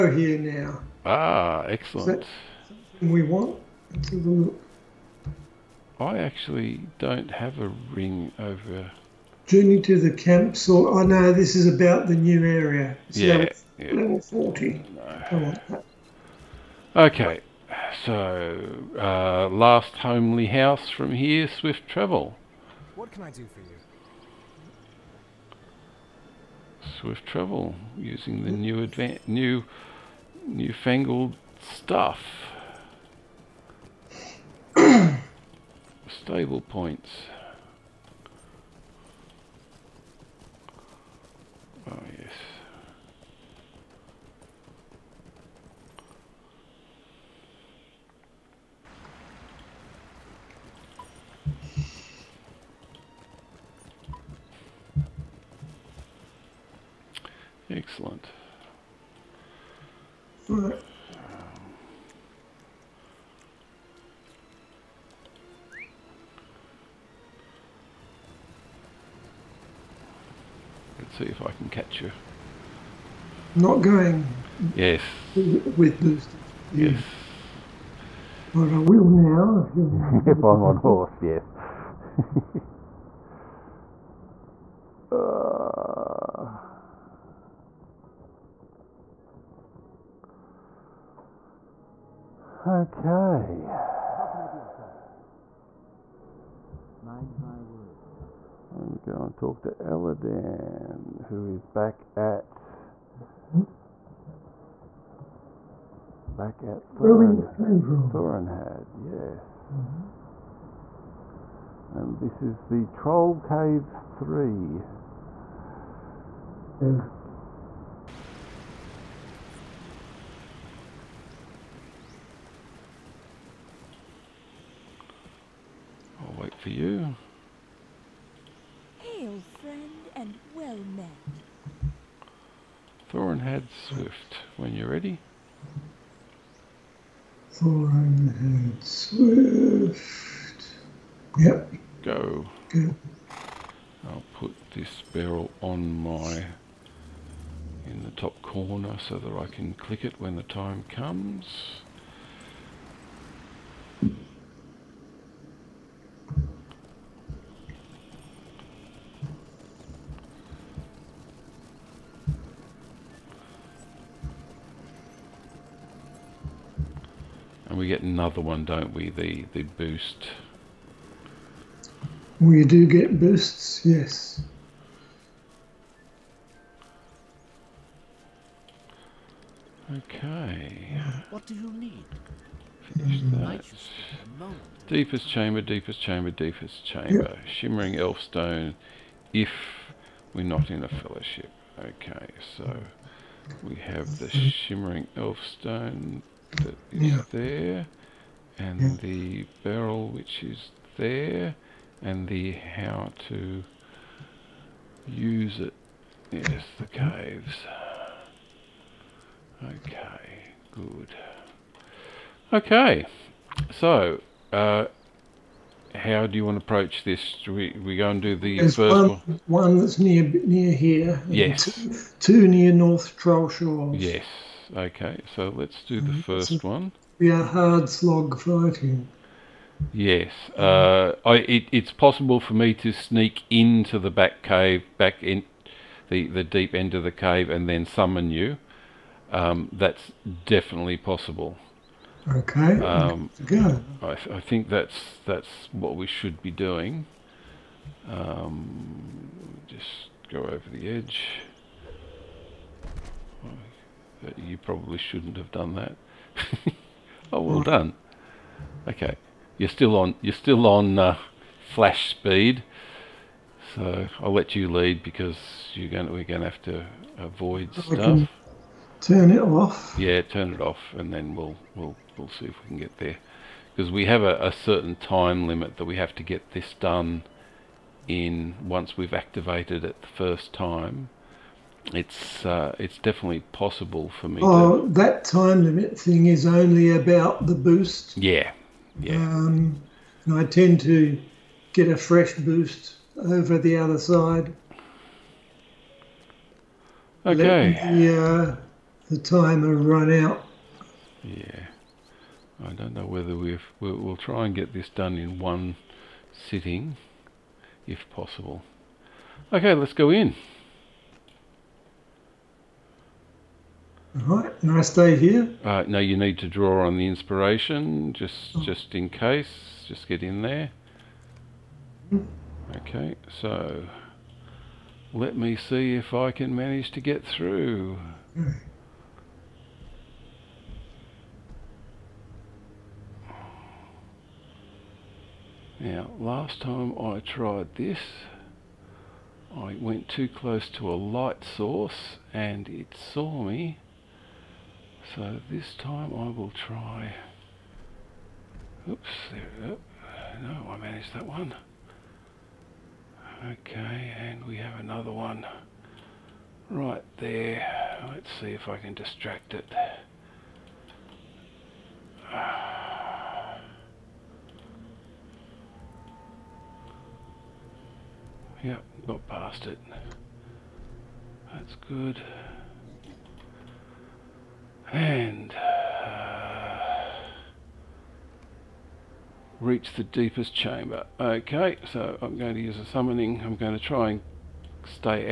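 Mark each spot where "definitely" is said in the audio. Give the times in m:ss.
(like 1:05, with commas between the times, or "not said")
4:00, 4:42.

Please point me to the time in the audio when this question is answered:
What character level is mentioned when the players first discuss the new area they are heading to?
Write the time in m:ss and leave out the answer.
0:13.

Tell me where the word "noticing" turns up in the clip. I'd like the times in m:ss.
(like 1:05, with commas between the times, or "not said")
not said.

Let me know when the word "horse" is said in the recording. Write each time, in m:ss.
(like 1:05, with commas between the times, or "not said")
1:20.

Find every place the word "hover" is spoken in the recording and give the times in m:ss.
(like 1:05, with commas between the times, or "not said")
not said.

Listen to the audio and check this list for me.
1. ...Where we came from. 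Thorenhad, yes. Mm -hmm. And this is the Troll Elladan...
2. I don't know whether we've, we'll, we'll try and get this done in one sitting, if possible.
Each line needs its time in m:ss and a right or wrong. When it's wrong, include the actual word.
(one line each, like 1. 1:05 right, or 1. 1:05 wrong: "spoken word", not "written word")
1. 1:47 wrong: "Caves", not "Elladan"
2. 5:02 right.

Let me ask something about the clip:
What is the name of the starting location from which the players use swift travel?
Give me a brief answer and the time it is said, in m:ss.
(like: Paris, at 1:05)
Last Homely House, at 0:19.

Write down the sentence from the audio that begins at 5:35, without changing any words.
Now, last time I tried this, I went too close to a light source and it saw me.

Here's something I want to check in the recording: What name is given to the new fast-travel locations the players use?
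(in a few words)
Stable points.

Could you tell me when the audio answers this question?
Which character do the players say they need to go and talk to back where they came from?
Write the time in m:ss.
1:39.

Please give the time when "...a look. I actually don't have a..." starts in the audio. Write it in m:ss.
0:04.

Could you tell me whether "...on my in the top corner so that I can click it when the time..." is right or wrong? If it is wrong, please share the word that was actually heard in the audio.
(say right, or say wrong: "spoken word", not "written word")
right.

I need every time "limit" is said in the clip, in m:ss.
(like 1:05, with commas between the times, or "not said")
4:35, 4:45.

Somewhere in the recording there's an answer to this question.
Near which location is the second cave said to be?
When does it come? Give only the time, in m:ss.
3:42.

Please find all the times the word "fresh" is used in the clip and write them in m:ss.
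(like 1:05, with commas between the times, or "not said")
4:51.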